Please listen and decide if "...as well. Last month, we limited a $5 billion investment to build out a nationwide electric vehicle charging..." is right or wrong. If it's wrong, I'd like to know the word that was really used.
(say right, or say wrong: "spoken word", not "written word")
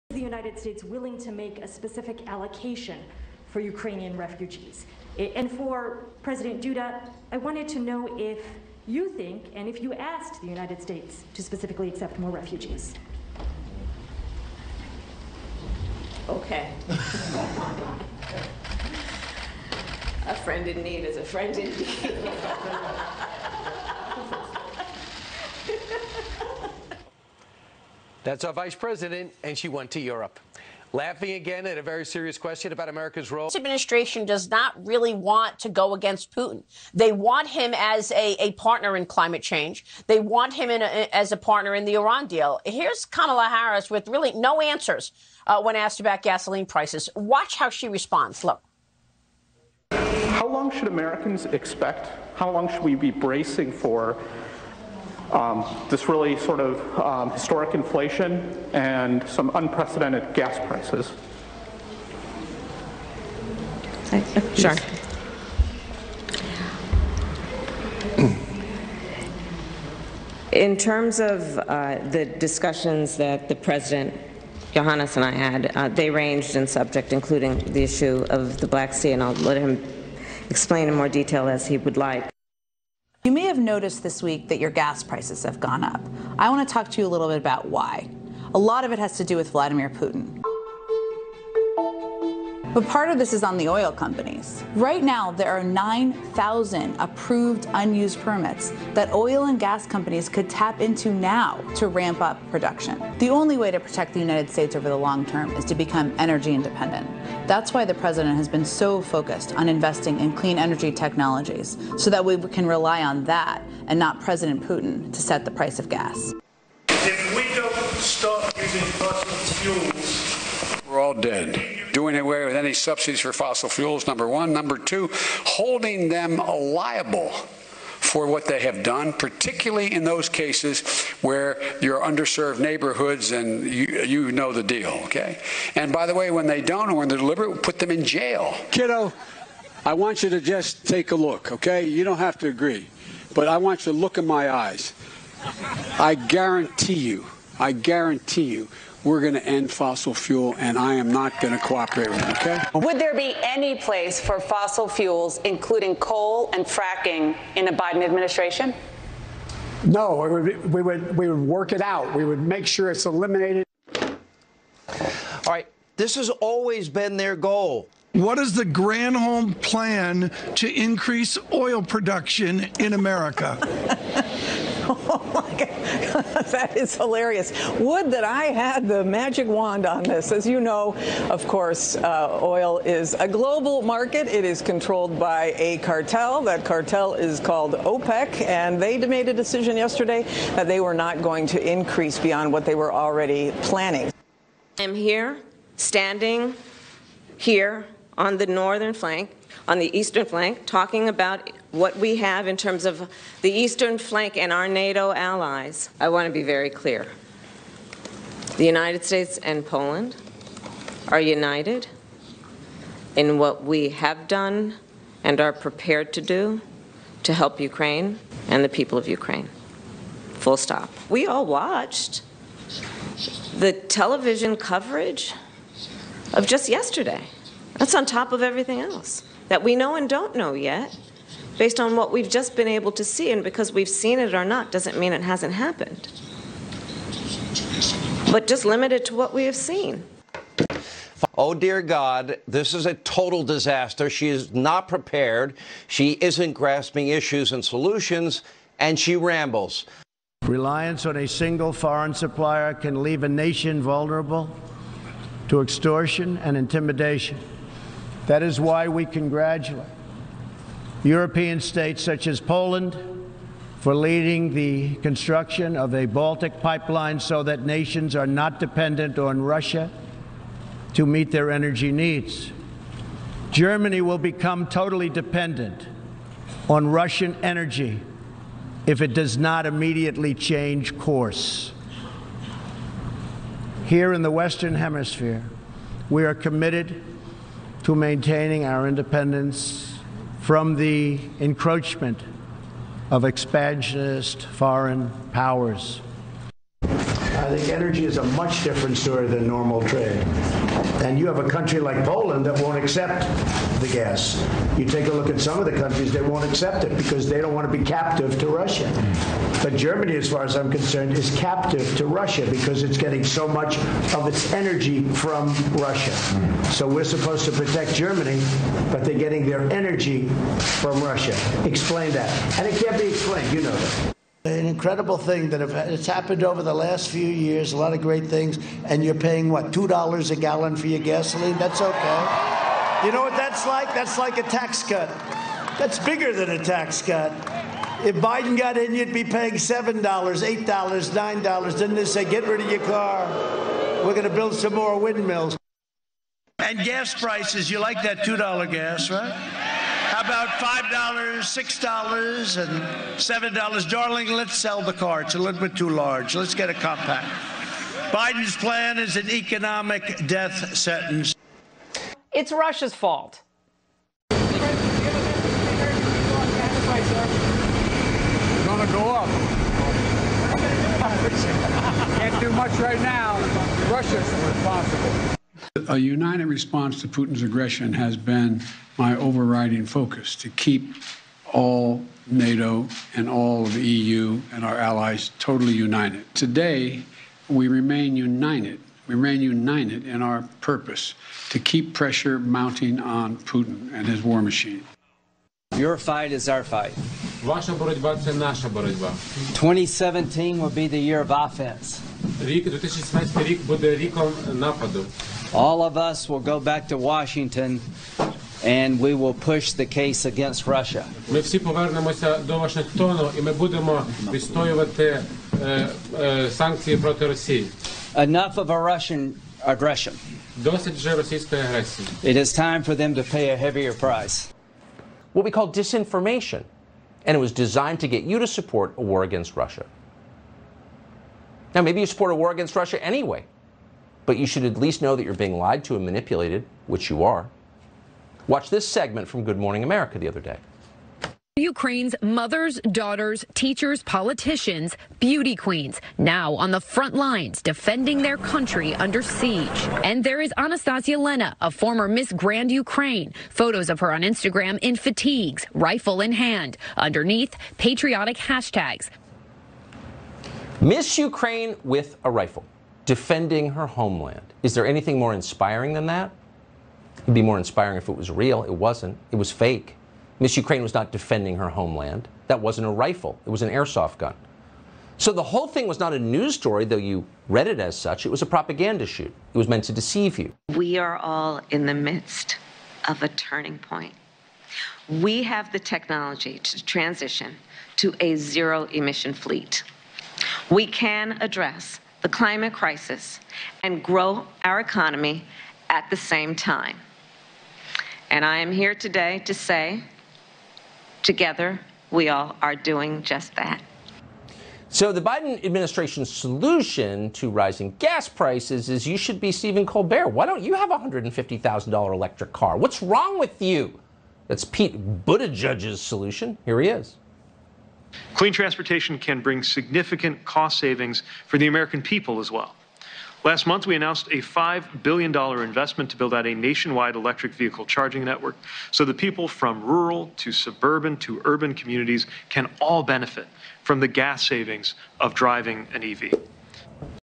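wrong: "announced", not "limited".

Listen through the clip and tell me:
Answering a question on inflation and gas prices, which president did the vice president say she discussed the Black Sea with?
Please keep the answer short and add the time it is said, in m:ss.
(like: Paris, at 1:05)
Iohannis, at 1:14.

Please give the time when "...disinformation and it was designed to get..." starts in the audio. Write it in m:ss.
7:05.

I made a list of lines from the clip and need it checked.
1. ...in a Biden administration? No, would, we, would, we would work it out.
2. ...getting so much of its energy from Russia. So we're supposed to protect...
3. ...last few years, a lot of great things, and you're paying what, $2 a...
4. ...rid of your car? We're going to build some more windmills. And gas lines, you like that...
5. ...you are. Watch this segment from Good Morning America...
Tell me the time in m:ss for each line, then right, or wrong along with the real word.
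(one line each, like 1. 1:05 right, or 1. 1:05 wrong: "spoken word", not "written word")
1. 2:37 right
2. 5:12 right
3. 5:26 right
4. 5:42 wrong: "prices", not "lines"
5. 7:17 right.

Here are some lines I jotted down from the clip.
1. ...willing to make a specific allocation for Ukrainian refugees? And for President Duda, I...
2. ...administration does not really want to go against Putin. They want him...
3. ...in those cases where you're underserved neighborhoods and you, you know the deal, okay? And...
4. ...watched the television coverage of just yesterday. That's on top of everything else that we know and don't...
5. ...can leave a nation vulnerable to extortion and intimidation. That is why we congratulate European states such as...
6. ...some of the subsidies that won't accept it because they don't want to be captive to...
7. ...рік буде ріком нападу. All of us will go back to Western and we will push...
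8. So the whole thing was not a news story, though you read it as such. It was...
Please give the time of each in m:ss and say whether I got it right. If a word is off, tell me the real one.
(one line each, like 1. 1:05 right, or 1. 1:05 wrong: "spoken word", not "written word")
1. 0:00 right
2. 0:33 right
3. 2:09 right
4. 3:41 right
5. 4:12 right
6. 5:05 wrong: "countries", not "subsidies"
7. 6:43 wrong: "Washington", not "Western"
8. 7:55 right.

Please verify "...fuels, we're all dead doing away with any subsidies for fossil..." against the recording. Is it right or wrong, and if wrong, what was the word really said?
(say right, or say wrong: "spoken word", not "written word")
right.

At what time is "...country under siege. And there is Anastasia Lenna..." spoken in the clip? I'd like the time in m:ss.
7:28.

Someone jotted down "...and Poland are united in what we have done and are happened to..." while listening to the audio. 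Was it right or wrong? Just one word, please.
wrong.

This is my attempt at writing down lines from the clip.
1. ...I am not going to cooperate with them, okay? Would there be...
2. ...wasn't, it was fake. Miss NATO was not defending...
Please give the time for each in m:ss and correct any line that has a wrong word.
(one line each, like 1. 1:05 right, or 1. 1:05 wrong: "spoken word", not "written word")
1. 2:30 right
2. 7:48 wrong: "Ukraine", not "NATO".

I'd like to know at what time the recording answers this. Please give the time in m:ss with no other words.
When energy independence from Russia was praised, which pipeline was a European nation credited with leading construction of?
4:26.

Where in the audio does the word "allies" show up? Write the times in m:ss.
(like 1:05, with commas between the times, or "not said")
3:25, 6:24.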